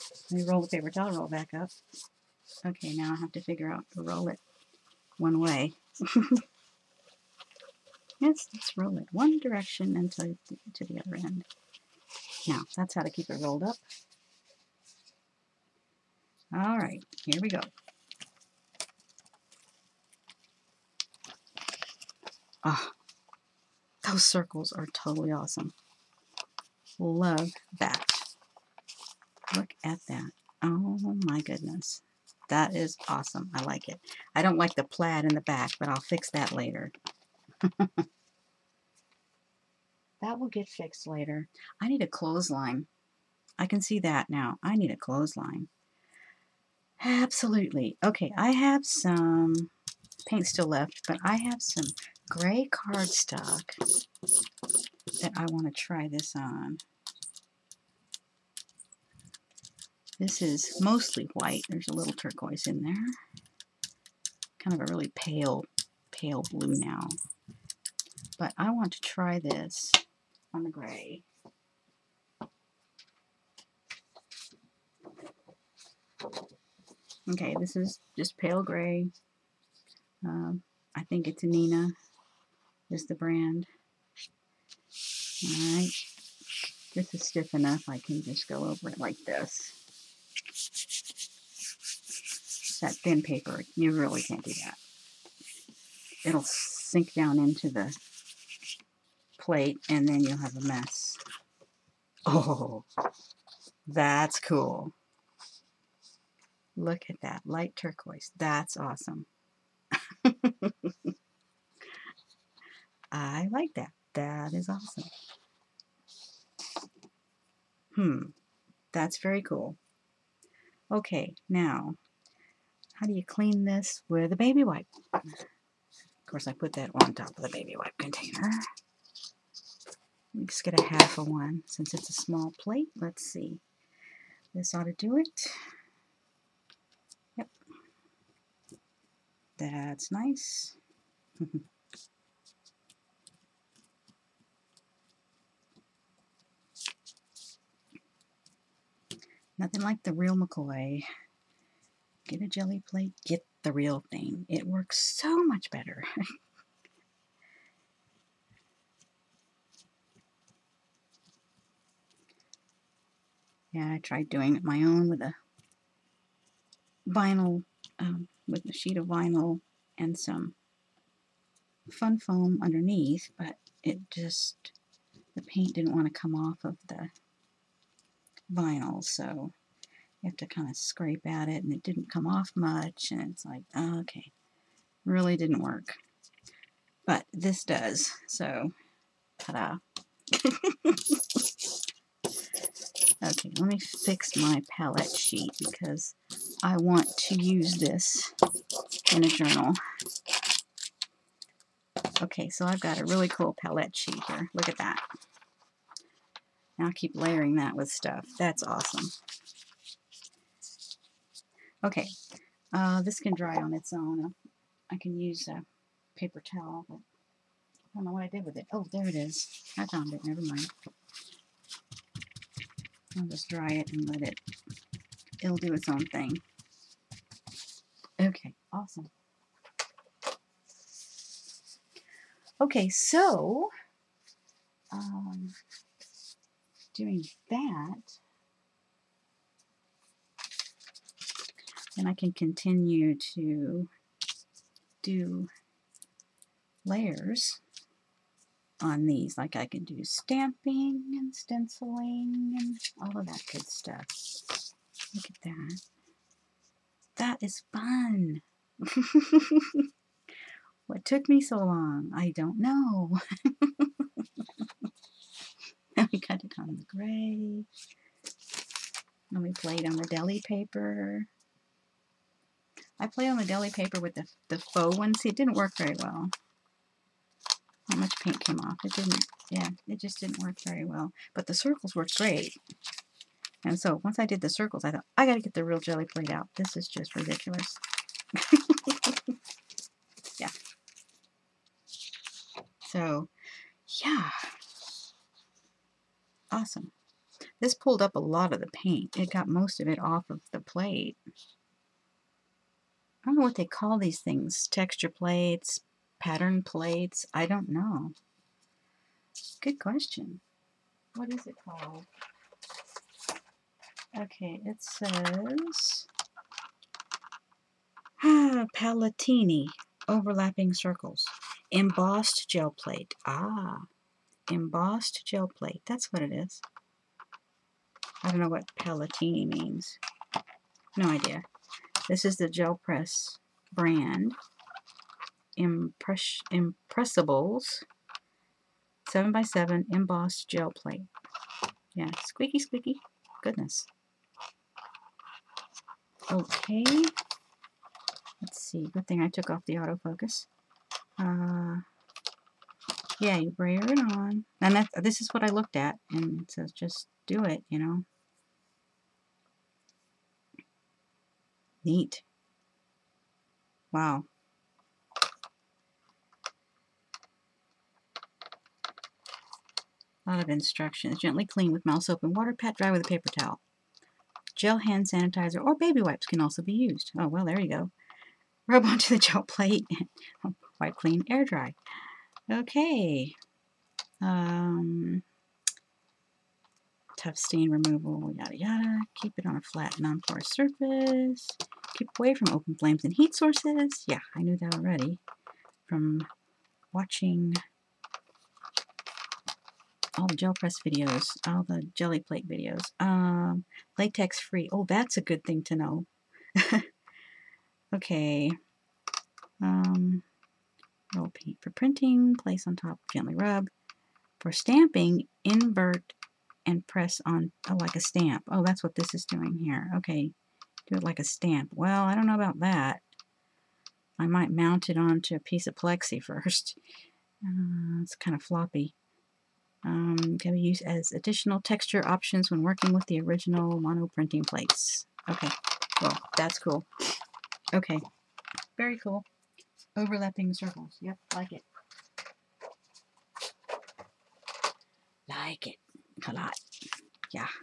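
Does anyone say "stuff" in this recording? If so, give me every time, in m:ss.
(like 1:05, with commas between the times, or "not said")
3:27, 4:13.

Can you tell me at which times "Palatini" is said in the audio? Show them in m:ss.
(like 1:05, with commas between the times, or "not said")
5:18, 5:28.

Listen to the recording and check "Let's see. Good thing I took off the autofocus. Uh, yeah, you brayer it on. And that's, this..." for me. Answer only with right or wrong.
right.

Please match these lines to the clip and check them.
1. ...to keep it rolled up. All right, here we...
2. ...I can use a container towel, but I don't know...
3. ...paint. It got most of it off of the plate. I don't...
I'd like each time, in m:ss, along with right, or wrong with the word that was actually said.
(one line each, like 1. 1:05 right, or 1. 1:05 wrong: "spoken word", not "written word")
1. 0:13 right
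2. 3:34 wrong: "paper", not "container"
3. 4:58 right.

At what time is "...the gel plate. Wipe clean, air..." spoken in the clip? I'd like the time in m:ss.
6:19.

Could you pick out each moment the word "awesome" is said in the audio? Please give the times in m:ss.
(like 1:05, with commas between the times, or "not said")
0:25, 0:33, 1:48, 1:54, 3:28, 3:48, 4:56.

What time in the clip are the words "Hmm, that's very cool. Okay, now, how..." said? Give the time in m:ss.
1:57.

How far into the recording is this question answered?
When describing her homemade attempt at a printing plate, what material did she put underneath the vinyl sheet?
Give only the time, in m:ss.
2:51.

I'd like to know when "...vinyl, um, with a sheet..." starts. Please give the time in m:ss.
2:47.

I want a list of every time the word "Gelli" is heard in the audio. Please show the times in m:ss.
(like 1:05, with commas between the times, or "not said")
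2:32, 4:45, 6:41.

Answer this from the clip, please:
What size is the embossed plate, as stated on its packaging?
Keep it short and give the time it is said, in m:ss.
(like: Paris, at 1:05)
7x7, at 5:39.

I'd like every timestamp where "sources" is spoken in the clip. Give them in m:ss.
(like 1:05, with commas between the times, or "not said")
6:33.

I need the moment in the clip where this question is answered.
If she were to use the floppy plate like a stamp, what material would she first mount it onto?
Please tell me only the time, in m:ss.
7:05.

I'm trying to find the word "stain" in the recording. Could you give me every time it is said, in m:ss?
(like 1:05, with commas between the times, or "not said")
6:27.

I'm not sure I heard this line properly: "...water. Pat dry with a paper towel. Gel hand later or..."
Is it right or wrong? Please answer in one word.
wrong.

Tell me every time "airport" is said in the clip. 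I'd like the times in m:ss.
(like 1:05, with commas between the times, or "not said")
not said.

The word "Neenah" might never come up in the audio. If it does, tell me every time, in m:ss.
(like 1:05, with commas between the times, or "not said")
1:21.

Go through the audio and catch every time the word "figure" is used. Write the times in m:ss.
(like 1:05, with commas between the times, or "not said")
0:03.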